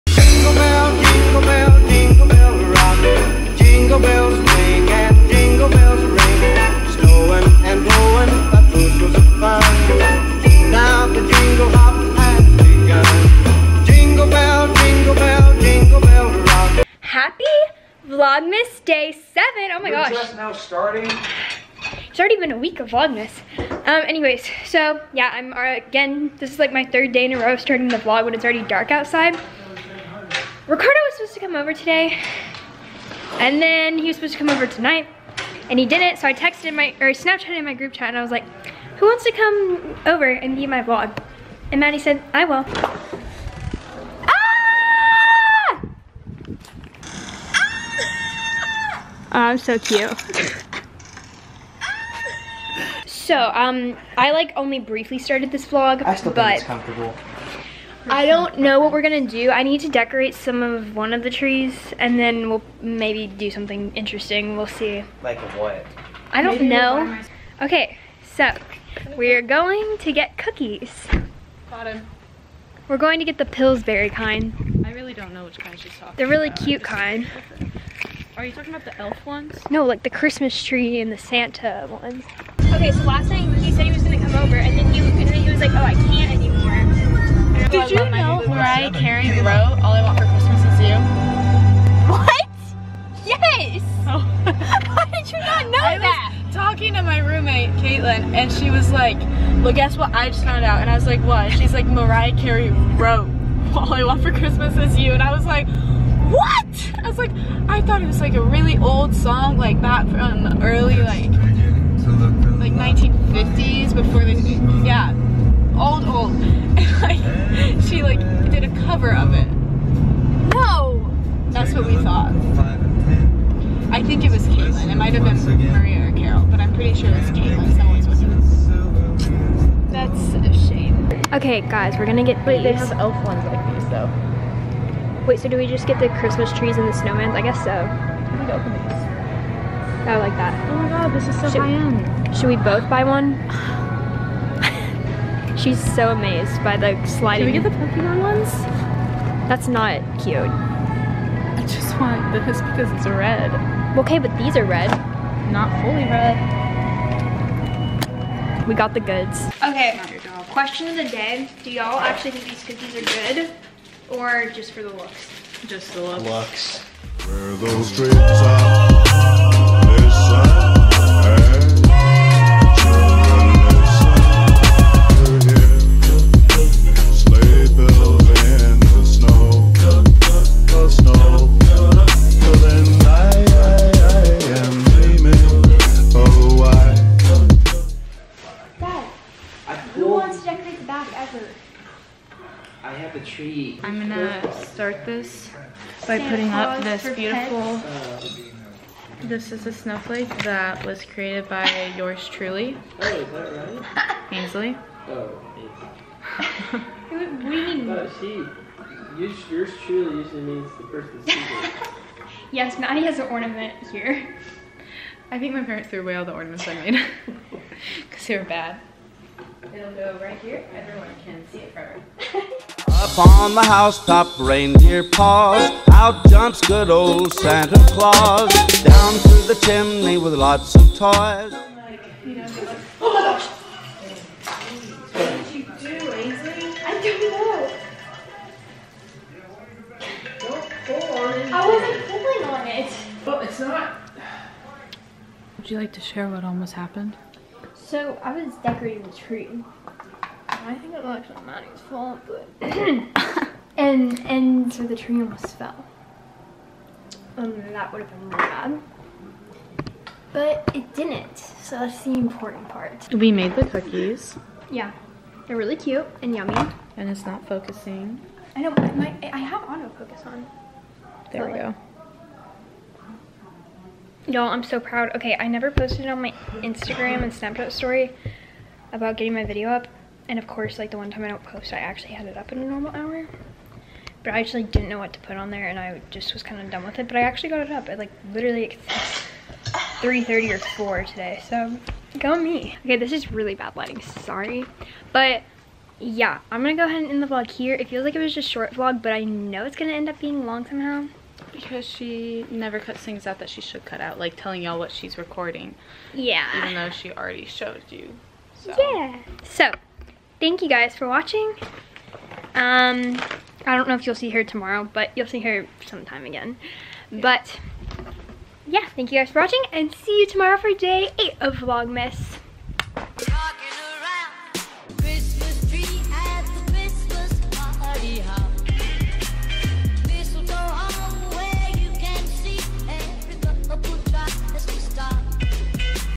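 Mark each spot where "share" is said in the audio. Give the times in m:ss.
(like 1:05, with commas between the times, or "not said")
4:06.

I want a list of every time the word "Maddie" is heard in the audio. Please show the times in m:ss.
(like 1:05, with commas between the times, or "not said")
0:41, 3:32, 4:11.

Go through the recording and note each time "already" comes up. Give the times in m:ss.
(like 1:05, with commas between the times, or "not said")
0:22, 0:28, 5:07.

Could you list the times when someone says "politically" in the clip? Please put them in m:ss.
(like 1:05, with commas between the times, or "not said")
not said.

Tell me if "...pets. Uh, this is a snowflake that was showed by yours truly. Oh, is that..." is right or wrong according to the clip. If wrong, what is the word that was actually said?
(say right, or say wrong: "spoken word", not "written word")
wrong: "created", not "showed".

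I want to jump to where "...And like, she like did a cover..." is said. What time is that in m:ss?
1:57.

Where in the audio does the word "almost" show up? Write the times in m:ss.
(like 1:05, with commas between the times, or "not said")
4:06, 4:15.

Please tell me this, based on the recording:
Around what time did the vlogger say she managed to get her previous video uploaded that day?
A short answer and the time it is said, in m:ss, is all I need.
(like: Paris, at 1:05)
3:30 or 4, at 4:49.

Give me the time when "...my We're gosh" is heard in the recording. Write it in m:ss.
0:19.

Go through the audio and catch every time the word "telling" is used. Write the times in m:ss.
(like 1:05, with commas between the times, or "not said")
5:04.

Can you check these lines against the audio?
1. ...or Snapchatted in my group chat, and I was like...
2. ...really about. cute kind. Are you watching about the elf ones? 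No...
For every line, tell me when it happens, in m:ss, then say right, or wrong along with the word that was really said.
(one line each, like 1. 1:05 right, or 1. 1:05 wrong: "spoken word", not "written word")
1. 0:37 right
2. 1:16 wrong: "talking", not "watching".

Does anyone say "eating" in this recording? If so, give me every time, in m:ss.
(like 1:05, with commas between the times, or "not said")
not said.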